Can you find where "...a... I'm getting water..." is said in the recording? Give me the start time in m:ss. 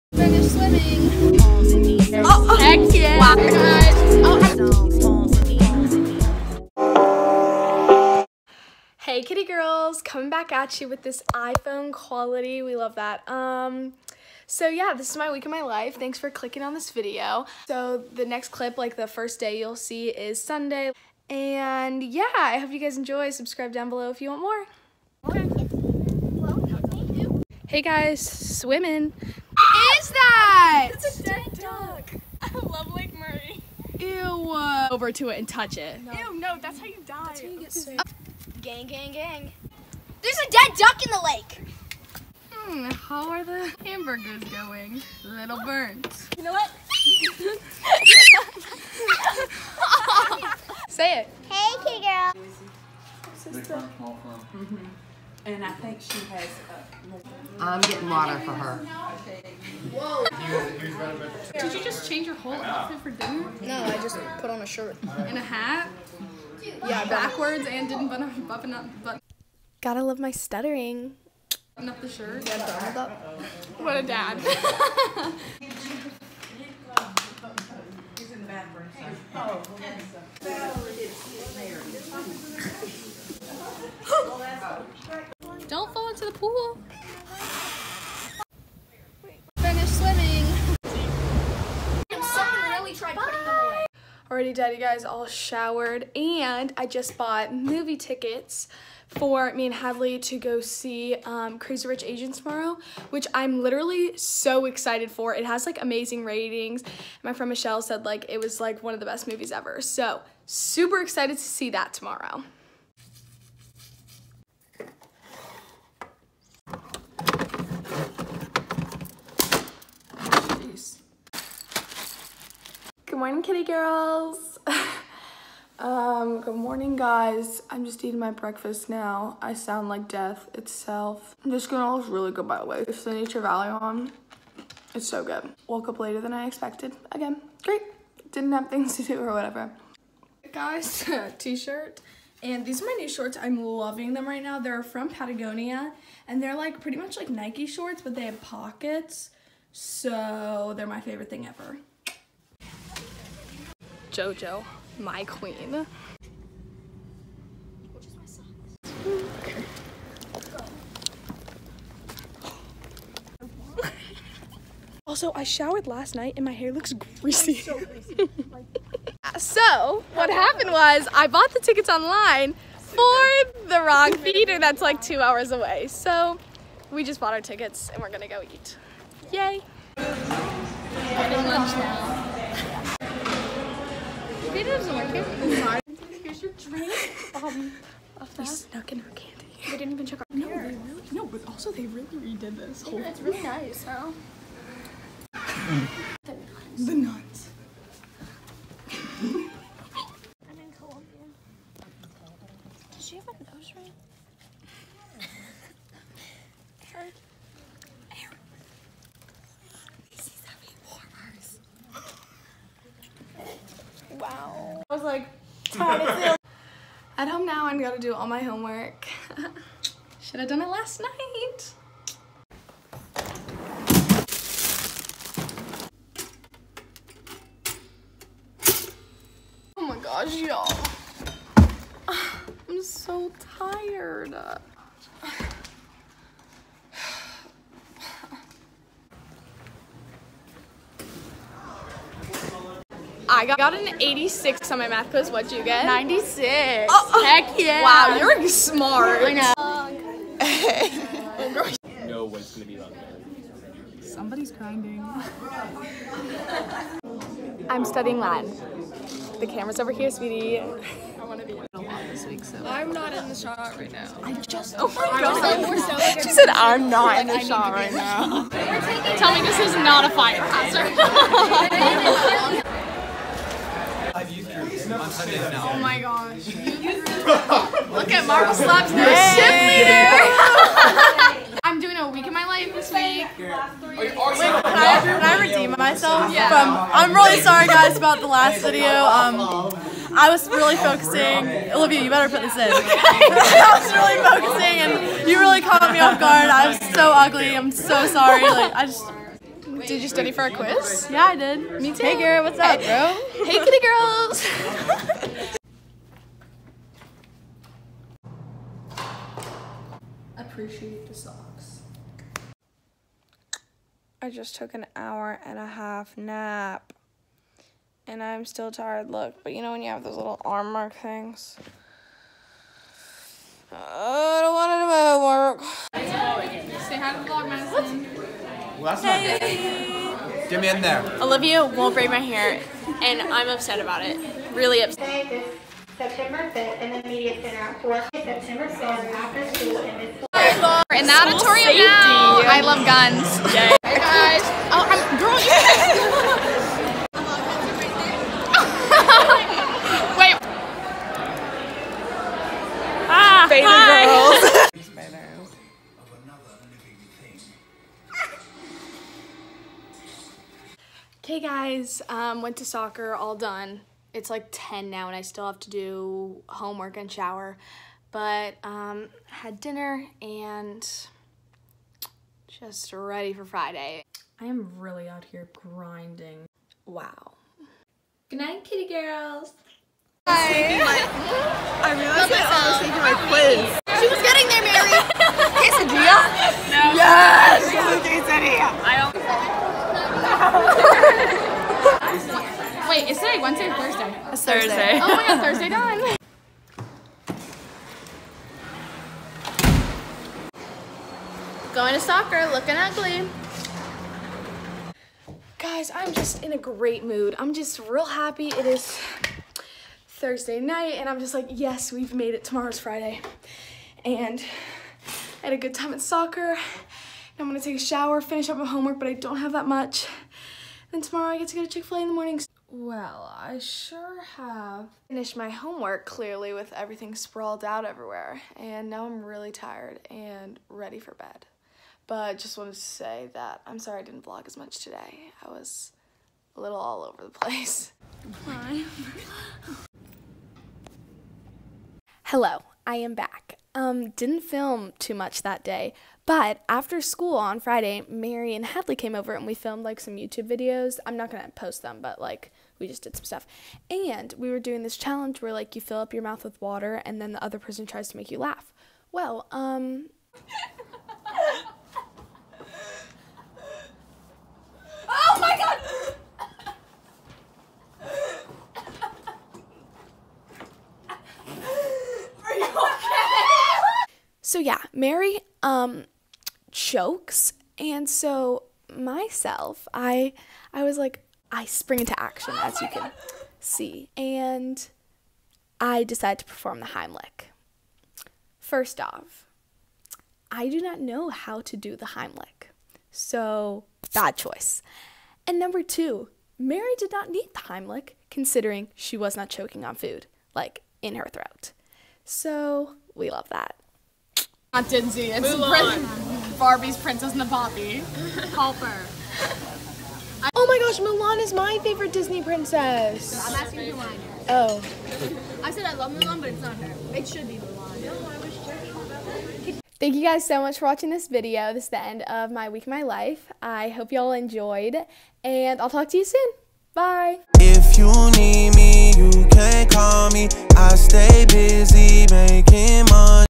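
0:57.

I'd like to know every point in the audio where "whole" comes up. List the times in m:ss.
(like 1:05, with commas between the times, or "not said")
1:02, 3:12.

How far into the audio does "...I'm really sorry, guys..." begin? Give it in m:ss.
4:46.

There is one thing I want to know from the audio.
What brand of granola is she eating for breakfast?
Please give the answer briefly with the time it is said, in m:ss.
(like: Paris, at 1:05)
Nature Valley, at 2:13.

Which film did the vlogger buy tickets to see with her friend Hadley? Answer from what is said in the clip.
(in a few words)
Crazy Rich Asians.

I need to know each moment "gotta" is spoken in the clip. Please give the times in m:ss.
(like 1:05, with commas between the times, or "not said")
1:09, 3:37.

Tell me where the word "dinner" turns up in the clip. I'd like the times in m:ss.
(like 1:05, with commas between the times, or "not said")
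1:03, 6:09.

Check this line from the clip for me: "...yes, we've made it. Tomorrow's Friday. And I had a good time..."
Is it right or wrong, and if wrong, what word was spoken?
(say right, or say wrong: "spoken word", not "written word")
right.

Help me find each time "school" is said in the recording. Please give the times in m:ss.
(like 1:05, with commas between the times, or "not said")
5:39, 7:27.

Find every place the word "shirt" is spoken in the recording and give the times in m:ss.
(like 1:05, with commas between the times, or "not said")
1:04, 1:12, 2:21.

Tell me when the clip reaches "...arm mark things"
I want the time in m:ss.
5:20.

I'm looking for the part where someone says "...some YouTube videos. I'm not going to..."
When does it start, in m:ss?
7:29.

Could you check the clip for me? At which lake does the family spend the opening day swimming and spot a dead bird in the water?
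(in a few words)
Lake Murray.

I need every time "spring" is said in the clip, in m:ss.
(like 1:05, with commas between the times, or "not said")
8:01.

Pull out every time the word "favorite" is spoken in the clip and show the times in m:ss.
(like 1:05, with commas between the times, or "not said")
2:31, 8:31.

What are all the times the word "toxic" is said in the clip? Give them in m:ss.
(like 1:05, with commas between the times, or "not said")
not said.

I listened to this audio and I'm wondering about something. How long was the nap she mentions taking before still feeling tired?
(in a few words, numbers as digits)
an hour and a half.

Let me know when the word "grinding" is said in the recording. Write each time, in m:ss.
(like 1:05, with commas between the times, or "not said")
4:14, 6:15.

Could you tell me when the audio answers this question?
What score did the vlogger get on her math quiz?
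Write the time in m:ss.
4:04.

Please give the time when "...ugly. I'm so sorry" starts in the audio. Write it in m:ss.
4:57.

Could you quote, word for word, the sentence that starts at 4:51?
Olivia, you better put this in.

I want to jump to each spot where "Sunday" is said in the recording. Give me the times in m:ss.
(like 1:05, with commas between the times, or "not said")
0:20, 4:35.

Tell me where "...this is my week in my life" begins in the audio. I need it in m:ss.
0:14.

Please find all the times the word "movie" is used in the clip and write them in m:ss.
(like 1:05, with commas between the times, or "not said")
1:37, 1:49.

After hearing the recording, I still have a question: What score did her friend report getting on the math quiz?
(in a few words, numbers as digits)
96.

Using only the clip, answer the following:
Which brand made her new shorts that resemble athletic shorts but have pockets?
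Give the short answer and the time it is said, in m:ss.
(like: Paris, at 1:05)
Patagonia, at 2:25.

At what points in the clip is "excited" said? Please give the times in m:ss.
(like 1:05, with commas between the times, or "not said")
1:44, 1:51.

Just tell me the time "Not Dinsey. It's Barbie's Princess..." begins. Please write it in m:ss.
8:24.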